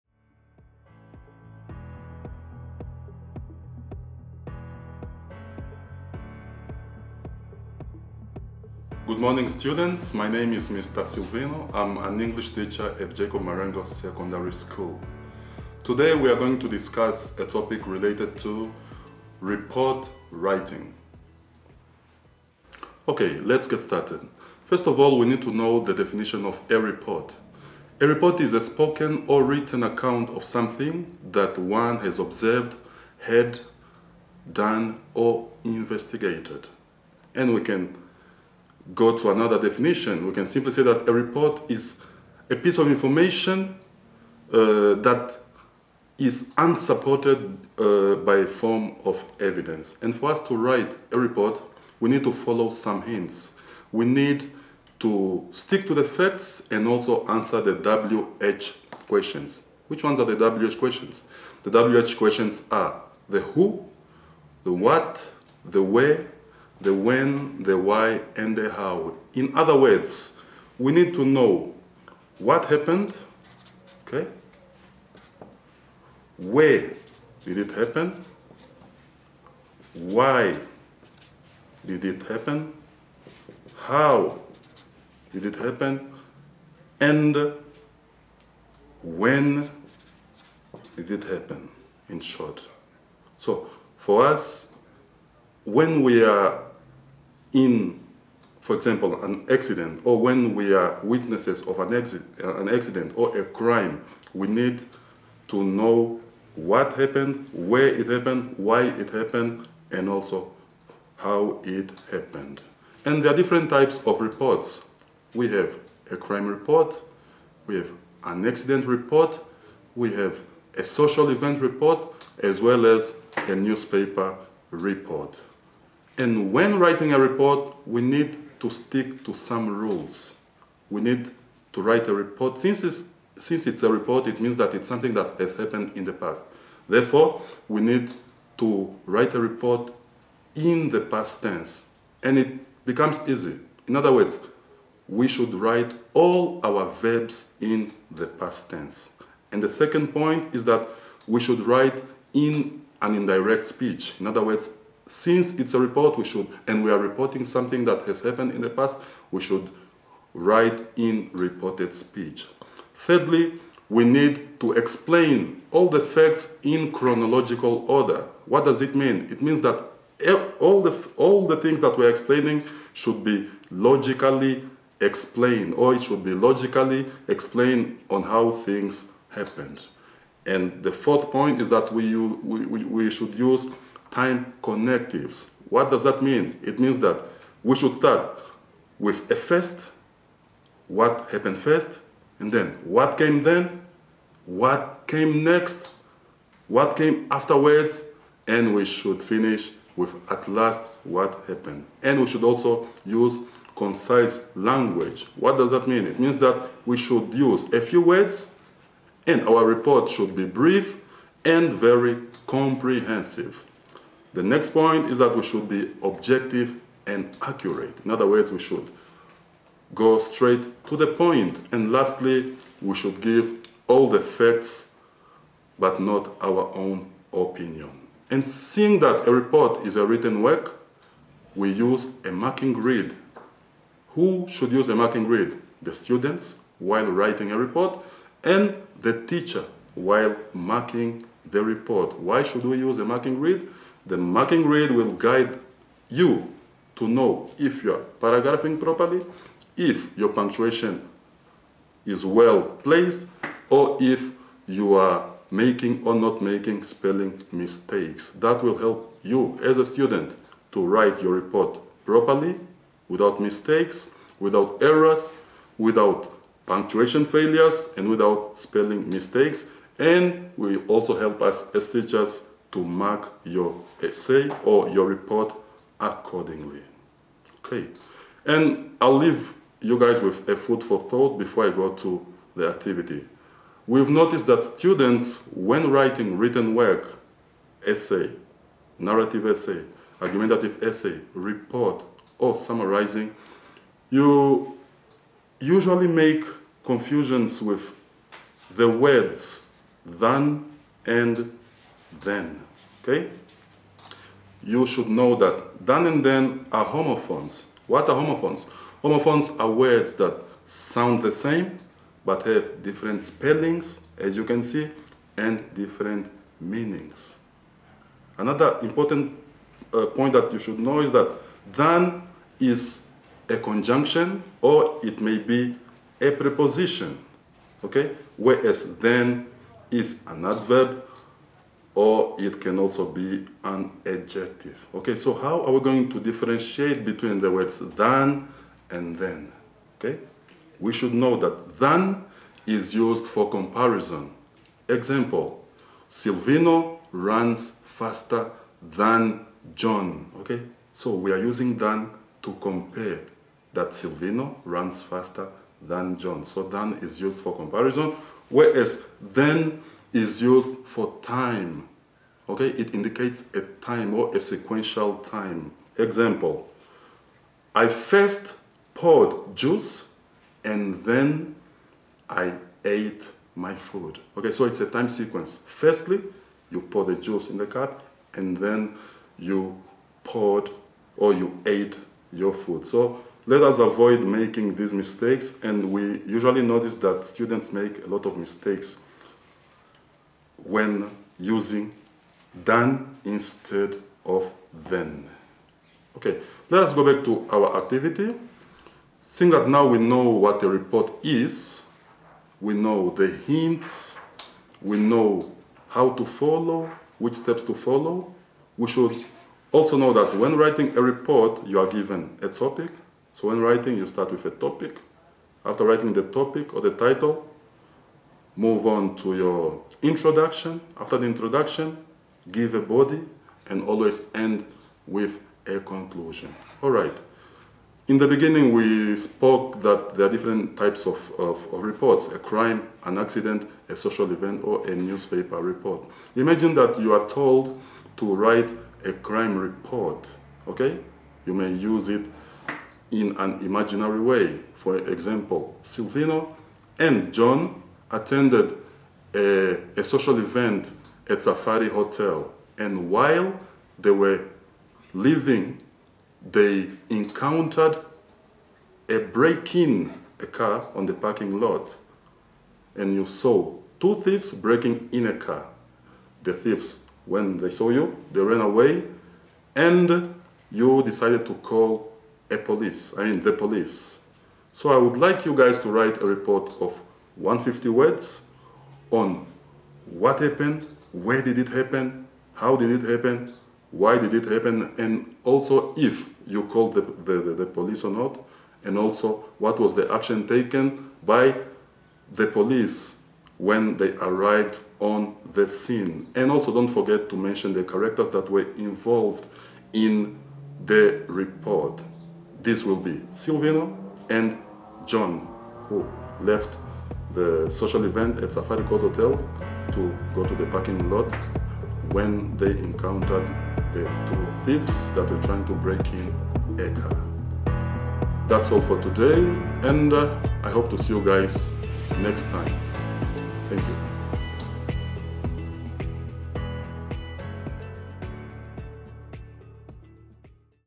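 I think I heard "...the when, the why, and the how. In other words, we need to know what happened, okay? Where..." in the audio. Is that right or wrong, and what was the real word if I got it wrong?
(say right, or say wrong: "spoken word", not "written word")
right.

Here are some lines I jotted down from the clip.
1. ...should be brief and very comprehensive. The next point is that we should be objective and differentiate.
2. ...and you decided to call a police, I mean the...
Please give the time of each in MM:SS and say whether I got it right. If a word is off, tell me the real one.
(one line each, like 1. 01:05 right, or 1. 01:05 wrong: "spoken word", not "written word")
1. 03:30 wrong: "accurate", not "differentiate"
2. 07:49 right.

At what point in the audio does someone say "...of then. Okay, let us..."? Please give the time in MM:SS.
06:34.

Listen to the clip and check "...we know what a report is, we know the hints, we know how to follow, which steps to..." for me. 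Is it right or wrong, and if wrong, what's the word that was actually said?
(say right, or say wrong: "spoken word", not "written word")
right.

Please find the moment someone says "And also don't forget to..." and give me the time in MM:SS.
08:16.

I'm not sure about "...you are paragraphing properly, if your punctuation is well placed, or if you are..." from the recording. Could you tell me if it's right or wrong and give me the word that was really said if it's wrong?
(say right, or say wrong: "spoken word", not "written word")
right.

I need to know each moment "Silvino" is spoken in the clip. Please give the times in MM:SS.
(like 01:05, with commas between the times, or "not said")
00:11, 05:46, 05:53, 07:25, 08:23.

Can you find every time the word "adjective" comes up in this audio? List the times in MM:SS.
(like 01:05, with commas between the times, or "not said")
05:34.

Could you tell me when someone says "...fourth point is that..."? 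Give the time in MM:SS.
03:00.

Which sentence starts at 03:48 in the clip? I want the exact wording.
And seeing that a report is a written work, we use a marking grid.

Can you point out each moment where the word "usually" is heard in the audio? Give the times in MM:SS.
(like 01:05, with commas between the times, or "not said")
04:55, 06:26.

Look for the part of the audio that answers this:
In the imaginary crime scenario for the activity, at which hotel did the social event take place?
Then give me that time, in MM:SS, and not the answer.
07:31.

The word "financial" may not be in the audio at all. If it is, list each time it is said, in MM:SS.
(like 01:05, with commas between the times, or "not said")
not said.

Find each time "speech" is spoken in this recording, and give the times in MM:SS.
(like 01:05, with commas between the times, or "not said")
02:33, 02:41.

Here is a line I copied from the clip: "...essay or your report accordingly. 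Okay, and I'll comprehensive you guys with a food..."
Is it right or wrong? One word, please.
wrong.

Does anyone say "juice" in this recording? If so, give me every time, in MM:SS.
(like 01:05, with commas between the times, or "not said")
06:09, 06:17.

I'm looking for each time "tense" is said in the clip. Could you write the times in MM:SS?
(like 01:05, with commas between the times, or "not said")
02:21, 02:28.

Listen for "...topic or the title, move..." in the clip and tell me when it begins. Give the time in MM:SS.
06:56.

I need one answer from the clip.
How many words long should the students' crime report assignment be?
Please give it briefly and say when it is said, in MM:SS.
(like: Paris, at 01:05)
150, at 07:57.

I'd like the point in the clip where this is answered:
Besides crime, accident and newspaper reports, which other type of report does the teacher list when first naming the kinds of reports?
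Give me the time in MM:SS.
02:00.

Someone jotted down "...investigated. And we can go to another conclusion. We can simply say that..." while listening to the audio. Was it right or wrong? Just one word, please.
wrong.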